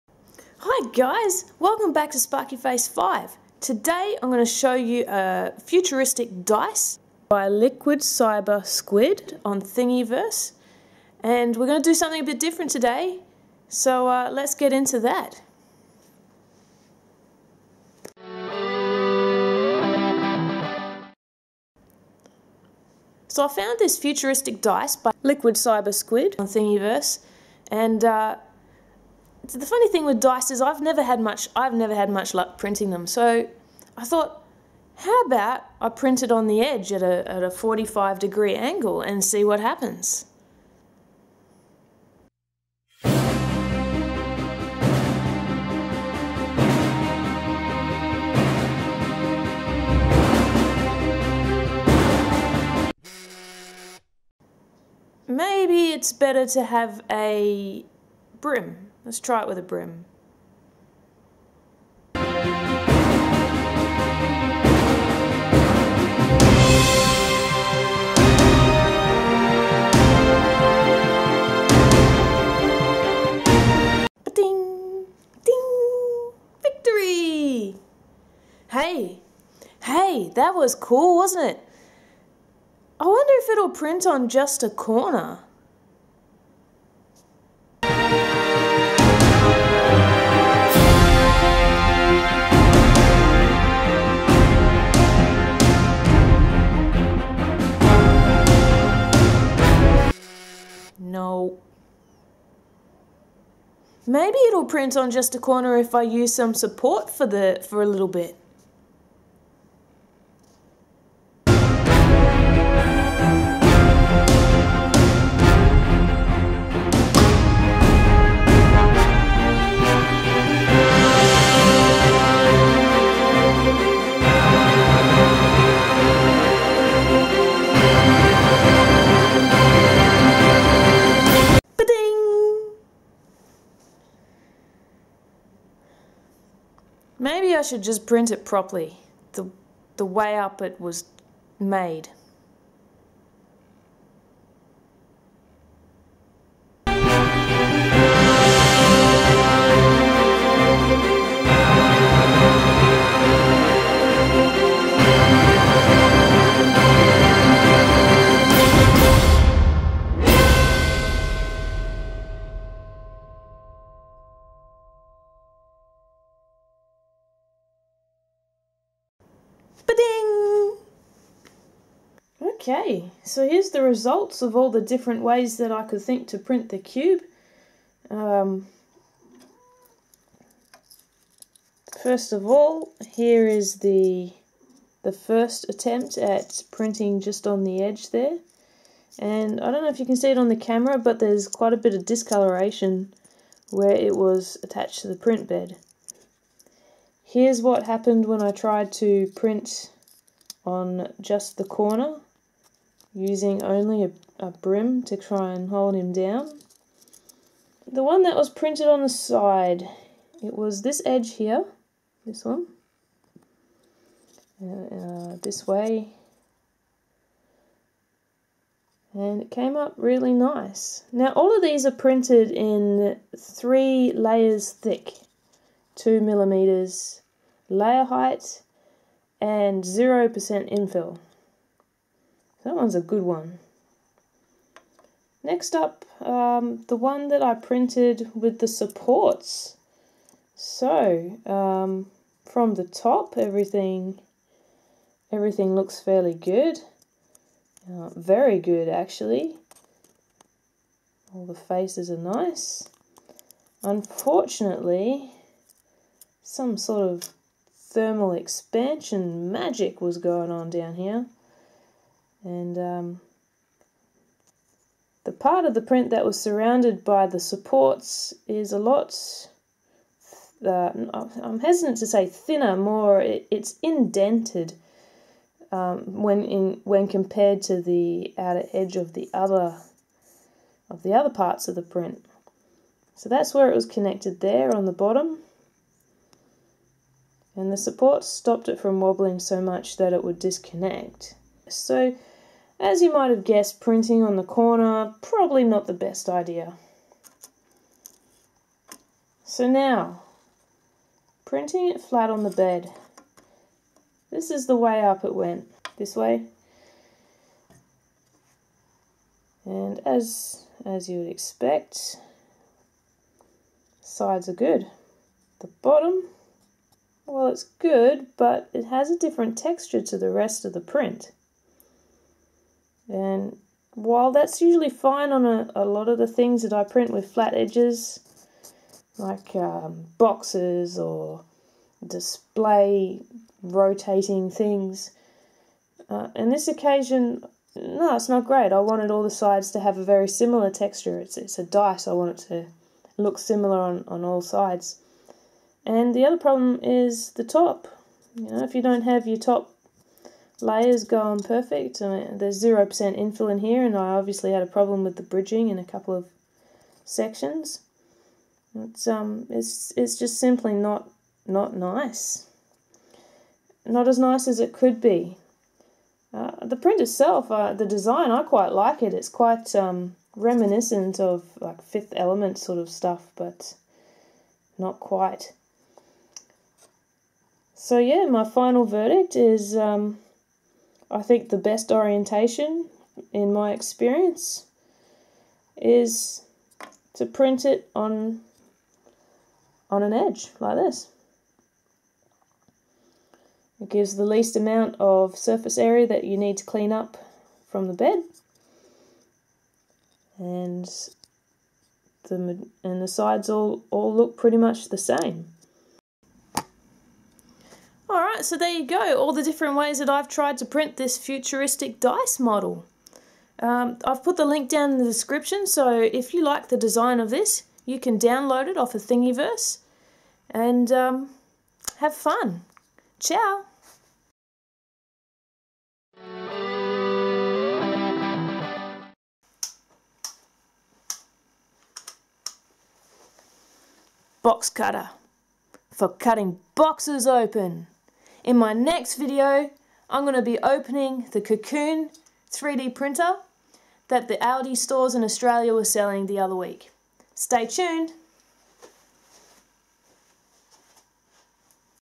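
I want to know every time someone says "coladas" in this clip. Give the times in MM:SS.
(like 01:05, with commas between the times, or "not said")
not said.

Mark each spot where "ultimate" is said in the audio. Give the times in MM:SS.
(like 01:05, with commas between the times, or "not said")
not said.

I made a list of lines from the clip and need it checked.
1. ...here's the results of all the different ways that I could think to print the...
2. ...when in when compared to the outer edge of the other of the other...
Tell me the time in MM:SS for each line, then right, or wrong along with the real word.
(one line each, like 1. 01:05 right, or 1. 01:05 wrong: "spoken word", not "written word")
1. 02:53 right
2. 04:36 right.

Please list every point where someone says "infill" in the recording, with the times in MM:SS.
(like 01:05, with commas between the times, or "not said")
03:50, 05:53.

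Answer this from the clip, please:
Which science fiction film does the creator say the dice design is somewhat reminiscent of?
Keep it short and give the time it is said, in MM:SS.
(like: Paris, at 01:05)
Fifth Element, at 06:11.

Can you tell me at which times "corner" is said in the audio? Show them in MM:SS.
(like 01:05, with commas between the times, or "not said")
01:24, 01:45, 03:21, 04:54.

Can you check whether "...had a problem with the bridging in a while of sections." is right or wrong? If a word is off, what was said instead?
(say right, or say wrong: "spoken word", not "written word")
wrong: "couple", not "while".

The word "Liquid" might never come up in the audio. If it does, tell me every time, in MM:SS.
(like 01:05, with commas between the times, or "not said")
00:07, 00:25.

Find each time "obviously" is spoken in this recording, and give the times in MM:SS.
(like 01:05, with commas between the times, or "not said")
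05:54.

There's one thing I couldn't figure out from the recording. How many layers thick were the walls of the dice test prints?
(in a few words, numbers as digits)
3.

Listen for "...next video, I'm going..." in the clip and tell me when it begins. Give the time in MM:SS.
07:18.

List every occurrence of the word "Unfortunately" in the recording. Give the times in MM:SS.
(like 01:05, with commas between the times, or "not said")
04:13.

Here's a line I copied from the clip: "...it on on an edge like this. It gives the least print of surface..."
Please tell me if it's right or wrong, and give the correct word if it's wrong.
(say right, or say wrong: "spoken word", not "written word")
wrong: "amount", not "print".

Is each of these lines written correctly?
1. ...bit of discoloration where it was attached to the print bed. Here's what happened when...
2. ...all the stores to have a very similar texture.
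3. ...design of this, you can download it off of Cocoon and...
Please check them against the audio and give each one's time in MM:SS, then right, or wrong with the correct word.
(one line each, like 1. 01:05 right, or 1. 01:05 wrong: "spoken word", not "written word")
1. 03:11 right
2. 05:39 wrong: "sides", not "stores"
3. 06:56 wrong: "Thingiverse", not "Cocoon".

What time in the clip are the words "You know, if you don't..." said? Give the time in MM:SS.
05:48.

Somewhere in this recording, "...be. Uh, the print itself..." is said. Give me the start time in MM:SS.
06:05.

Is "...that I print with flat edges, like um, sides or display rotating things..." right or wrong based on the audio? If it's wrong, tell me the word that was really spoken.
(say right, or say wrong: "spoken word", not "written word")
wrong: "boxes", not "sides".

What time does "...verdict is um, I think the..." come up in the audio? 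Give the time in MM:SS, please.
06:18.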